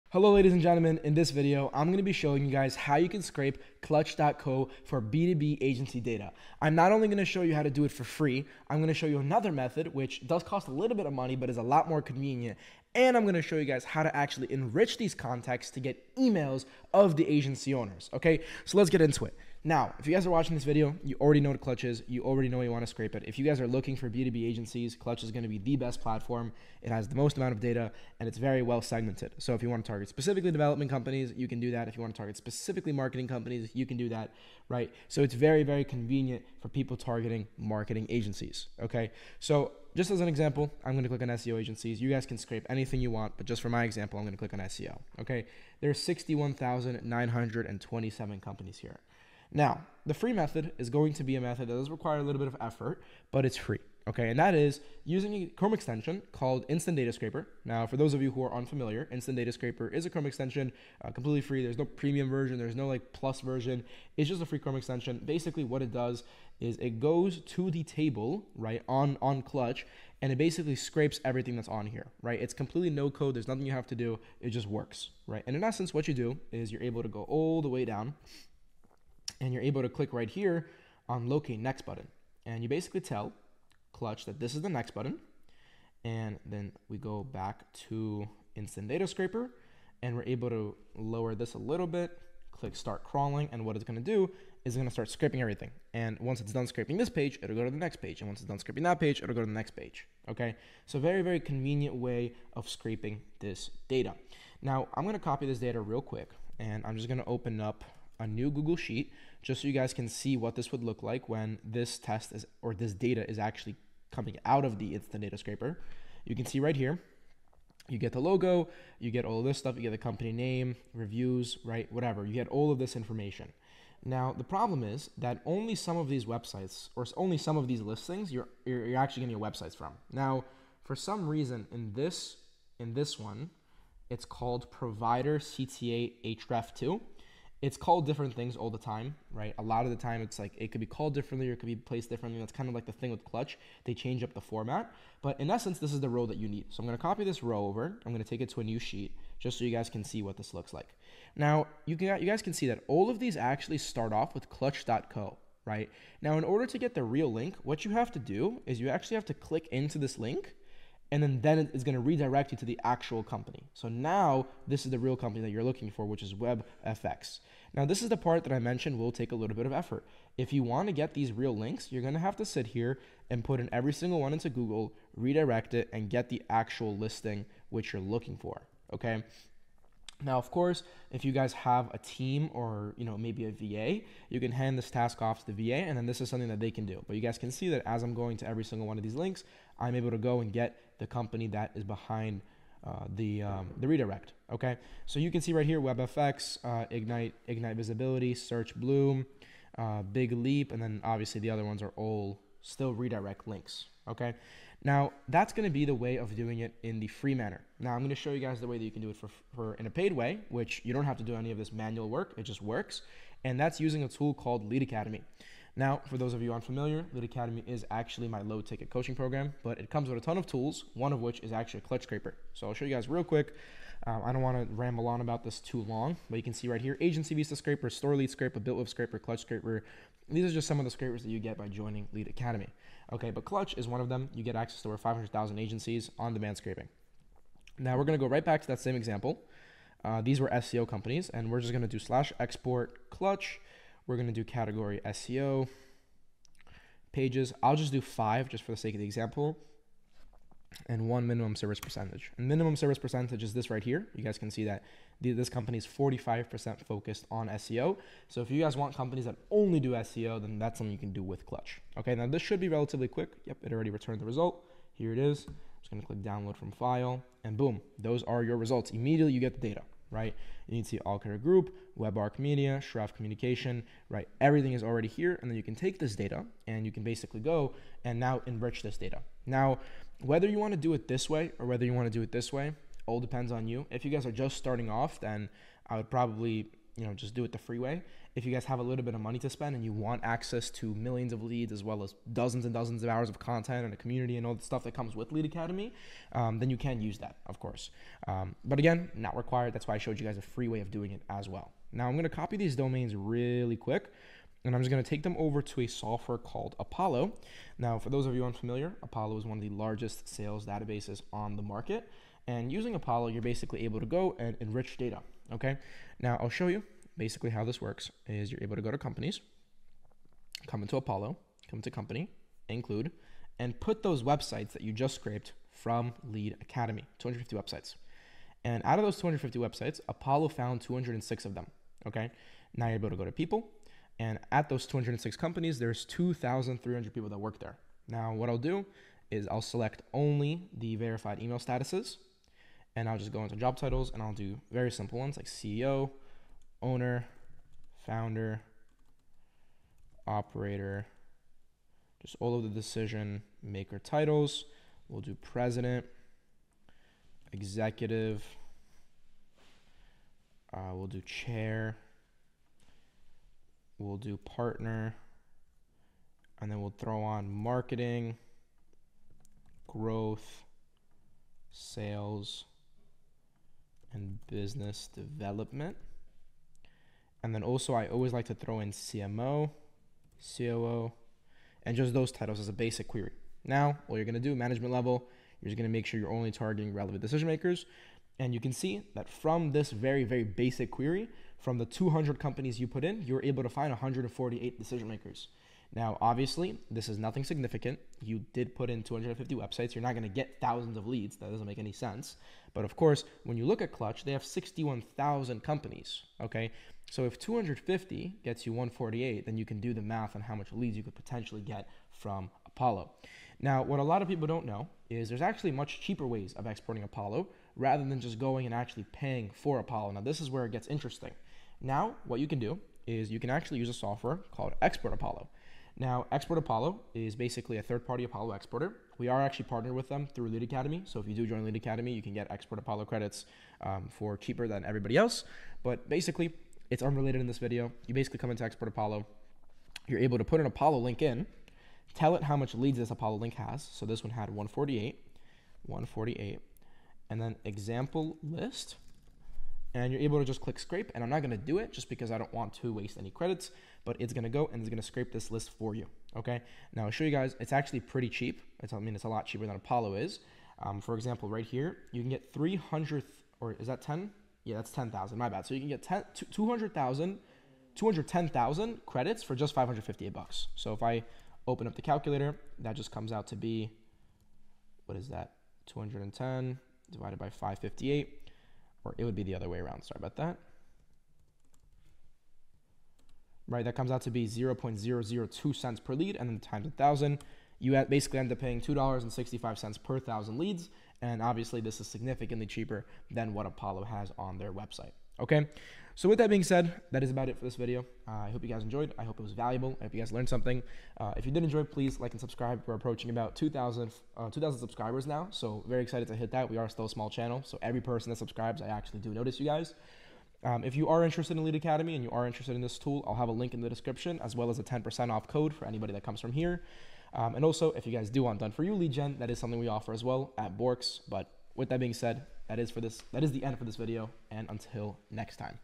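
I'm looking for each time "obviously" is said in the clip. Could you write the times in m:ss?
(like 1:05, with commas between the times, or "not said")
3:21, 6:36, 8:11.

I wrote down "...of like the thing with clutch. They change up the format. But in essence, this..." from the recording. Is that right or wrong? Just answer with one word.
right.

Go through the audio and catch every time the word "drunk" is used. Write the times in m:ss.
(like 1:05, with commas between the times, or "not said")
not said.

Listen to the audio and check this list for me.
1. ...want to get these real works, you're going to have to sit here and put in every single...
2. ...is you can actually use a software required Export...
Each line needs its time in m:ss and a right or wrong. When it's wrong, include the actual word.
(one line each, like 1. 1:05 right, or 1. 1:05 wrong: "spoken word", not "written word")
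1. 2:50 wrong: "links", not "works"
2. 7:03 wrong: "called", not "required".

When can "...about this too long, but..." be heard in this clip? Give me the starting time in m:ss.
3:45.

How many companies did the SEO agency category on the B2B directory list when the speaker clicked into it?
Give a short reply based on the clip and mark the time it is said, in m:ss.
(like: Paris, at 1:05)
61,927, at 0:45.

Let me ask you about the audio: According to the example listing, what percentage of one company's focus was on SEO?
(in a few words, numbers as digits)
45%.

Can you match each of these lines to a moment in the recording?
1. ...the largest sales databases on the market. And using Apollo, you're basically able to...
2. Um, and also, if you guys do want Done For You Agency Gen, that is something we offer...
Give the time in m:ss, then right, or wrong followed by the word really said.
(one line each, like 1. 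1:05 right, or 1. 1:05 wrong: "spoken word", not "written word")
1. 5:09 right
2. 8:37 wrong: "Lead", not "Agency".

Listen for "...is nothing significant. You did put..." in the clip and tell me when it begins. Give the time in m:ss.
6:37.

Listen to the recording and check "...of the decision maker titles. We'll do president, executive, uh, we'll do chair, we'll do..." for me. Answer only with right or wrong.
right.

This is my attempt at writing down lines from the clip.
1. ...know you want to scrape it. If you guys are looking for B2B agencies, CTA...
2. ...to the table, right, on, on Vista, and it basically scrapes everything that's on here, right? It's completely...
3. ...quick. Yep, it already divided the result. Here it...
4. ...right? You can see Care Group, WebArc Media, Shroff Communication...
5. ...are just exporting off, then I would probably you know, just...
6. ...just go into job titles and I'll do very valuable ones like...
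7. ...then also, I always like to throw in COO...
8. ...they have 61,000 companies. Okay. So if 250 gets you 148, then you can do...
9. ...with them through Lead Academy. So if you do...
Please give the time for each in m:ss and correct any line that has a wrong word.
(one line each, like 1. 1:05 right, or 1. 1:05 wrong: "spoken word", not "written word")
1. 0:22 wrong: "Clutch", not "CTA"
2. 1:07 wrong: "Clutch", not "Vista"
3. 4:23 wrong: "returned", not "divided"
4. 4:30 right
5. 4:44 wrong: "starting", not "exporting"
6. 5:43 wrong: "simple", not "valuable"
7. 6:17 wrong: "CMO", not "COO"
8. 6:44 right
9. 7:09 right.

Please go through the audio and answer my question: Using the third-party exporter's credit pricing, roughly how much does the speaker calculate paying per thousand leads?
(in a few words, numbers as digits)
$2.65.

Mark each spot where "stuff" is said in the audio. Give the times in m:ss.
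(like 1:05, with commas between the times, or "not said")
1:59, 4:54.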